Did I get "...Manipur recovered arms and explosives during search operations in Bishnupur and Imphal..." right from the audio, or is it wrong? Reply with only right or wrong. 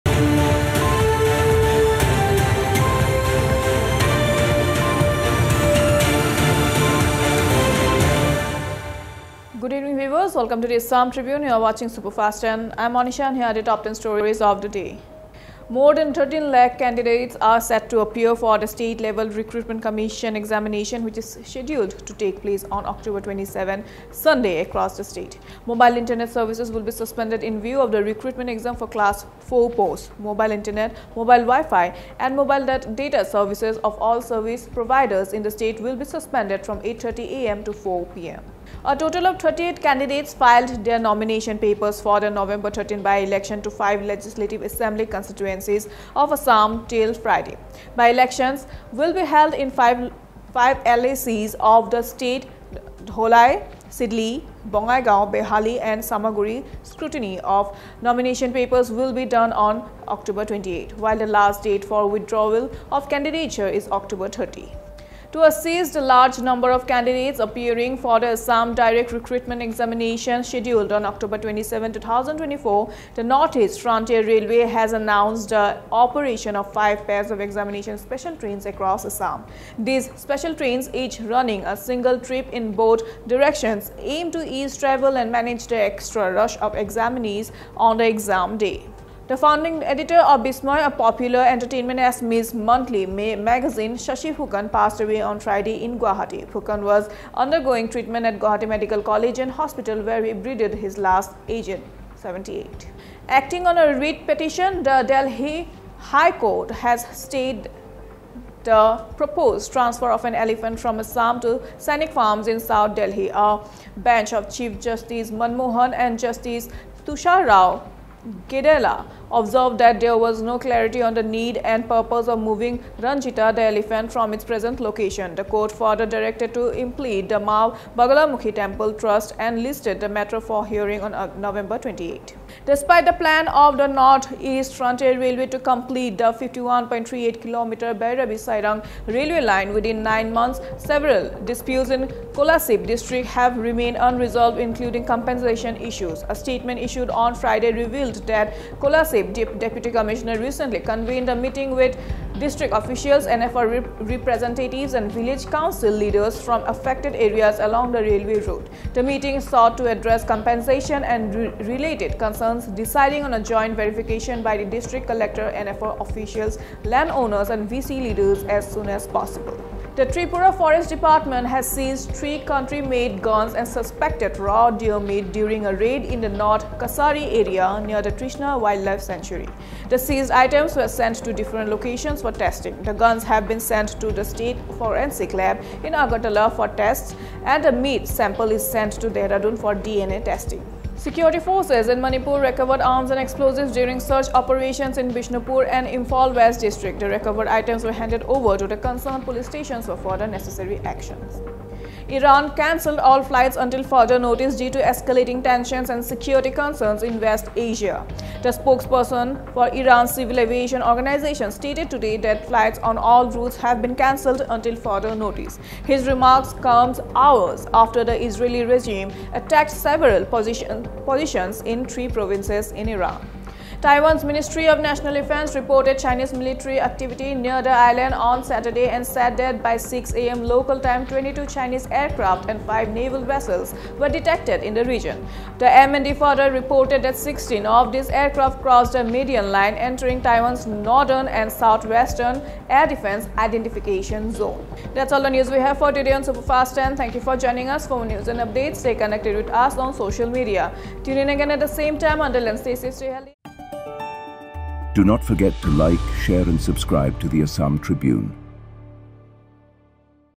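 right.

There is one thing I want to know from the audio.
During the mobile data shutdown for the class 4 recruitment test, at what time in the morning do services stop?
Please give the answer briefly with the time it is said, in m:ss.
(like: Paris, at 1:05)
8:30 a.m., at 0:36.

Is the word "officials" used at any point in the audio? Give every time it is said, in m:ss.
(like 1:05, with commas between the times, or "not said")
2:32, 2:46.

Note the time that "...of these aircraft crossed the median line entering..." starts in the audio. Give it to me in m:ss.
3:57.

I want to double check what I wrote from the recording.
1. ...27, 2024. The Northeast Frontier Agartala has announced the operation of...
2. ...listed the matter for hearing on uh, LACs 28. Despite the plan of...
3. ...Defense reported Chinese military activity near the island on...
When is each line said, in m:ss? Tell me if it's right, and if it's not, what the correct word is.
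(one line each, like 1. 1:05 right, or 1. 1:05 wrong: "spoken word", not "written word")
1. 1:11 wrong: "Railway", not "Agartala"
2. 2:09 wrong: "November", not "LACs"
3. 3:45 right.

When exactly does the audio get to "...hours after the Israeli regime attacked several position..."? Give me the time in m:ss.
3:37.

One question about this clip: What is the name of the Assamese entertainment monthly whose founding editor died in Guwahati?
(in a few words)
Bismay.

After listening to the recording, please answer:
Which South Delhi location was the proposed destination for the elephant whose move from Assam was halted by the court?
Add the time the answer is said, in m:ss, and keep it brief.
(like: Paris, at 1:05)
Sainik Farms, at 1:51.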